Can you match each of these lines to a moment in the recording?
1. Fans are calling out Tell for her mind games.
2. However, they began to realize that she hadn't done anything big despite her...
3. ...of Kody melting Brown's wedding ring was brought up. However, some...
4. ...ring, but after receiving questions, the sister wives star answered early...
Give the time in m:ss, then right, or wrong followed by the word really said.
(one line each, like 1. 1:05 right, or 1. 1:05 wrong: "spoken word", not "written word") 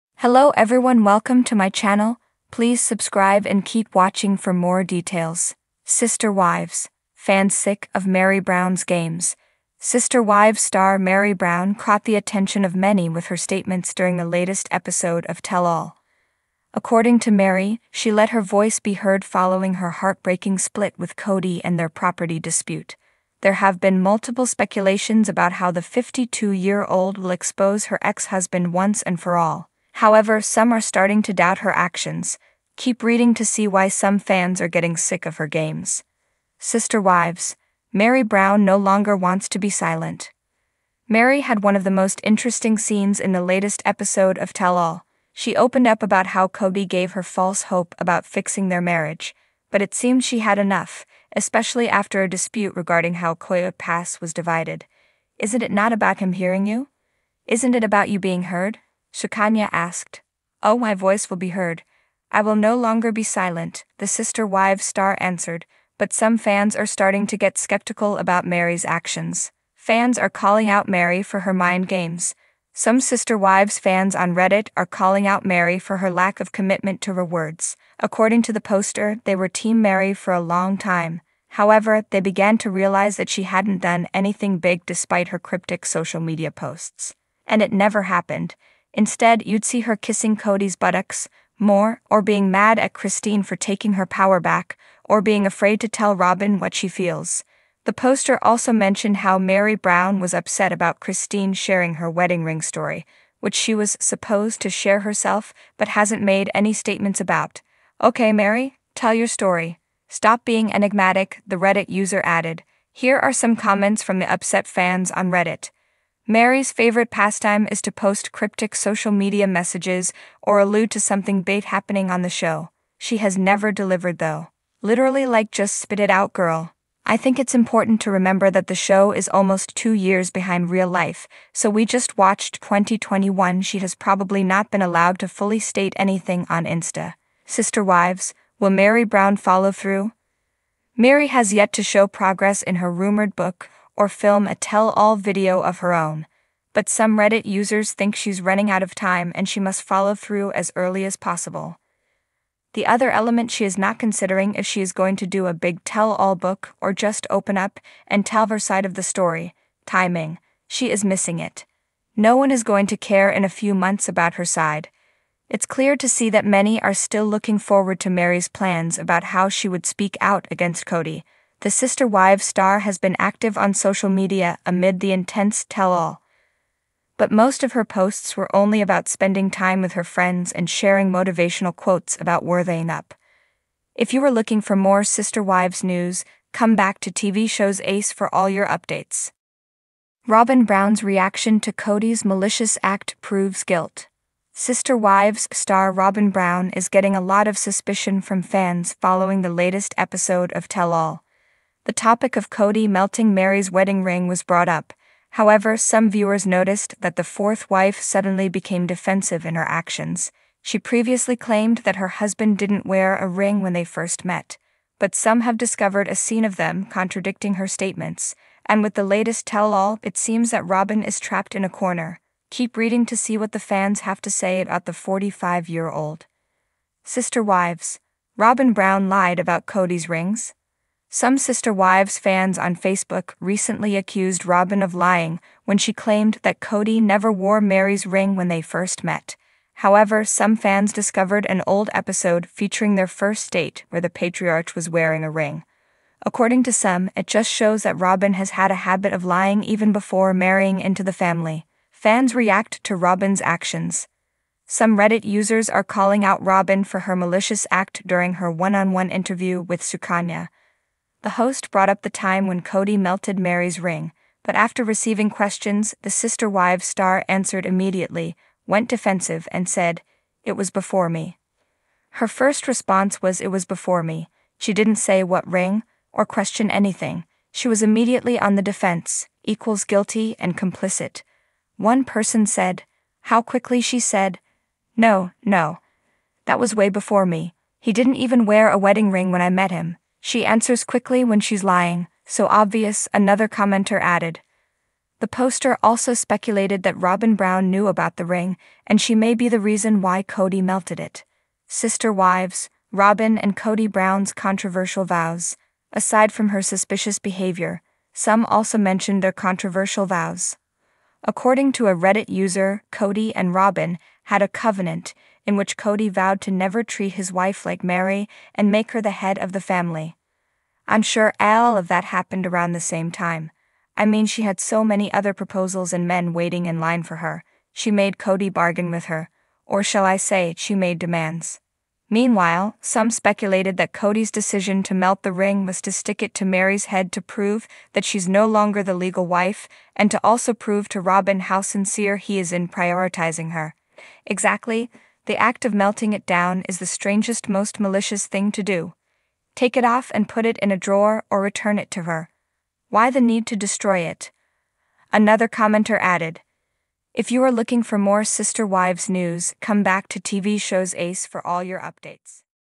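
1. 1:09 wrong: "Meri", not "Tell"
2. 1:21 right
3. 3:22 wrong: "Meri", not "Brown"
4. 4:23 wrong: "immediately", not "early".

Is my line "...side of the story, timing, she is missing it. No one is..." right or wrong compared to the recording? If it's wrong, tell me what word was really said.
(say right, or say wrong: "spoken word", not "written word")
right.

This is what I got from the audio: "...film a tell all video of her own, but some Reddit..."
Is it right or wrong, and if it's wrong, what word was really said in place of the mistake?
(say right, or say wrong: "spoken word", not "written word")
right.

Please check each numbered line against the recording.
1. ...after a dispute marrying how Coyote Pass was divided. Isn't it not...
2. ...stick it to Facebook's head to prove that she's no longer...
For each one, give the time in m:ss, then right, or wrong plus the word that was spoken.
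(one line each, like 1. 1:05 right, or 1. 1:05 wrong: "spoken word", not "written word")
1. 0:51 wrong: "regarding", not "marrying"
2. 5:35 wrong: "Meri", not "Facebook".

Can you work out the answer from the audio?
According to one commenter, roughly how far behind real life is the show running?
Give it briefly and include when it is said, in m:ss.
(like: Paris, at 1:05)
2 years, at 2:09.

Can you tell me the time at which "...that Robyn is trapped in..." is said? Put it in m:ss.
3:40.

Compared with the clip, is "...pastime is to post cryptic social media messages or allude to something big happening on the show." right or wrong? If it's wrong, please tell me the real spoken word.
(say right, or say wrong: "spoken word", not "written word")
right.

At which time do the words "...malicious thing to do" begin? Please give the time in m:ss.
5:47.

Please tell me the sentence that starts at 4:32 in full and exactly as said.
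Her first response was, It was before me.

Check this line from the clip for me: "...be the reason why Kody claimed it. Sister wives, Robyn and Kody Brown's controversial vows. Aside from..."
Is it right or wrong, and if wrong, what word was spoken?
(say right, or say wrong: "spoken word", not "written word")
wrong: "melted", not "claimed".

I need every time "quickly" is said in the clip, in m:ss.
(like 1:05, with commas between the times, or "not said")
4:43, 4:50.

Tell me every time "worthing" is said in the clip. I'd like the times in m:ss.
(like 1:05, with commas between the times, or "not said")
3:02.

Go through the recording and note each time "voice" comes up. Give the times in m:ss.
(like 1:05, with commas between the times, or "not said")
0:18, 1:00.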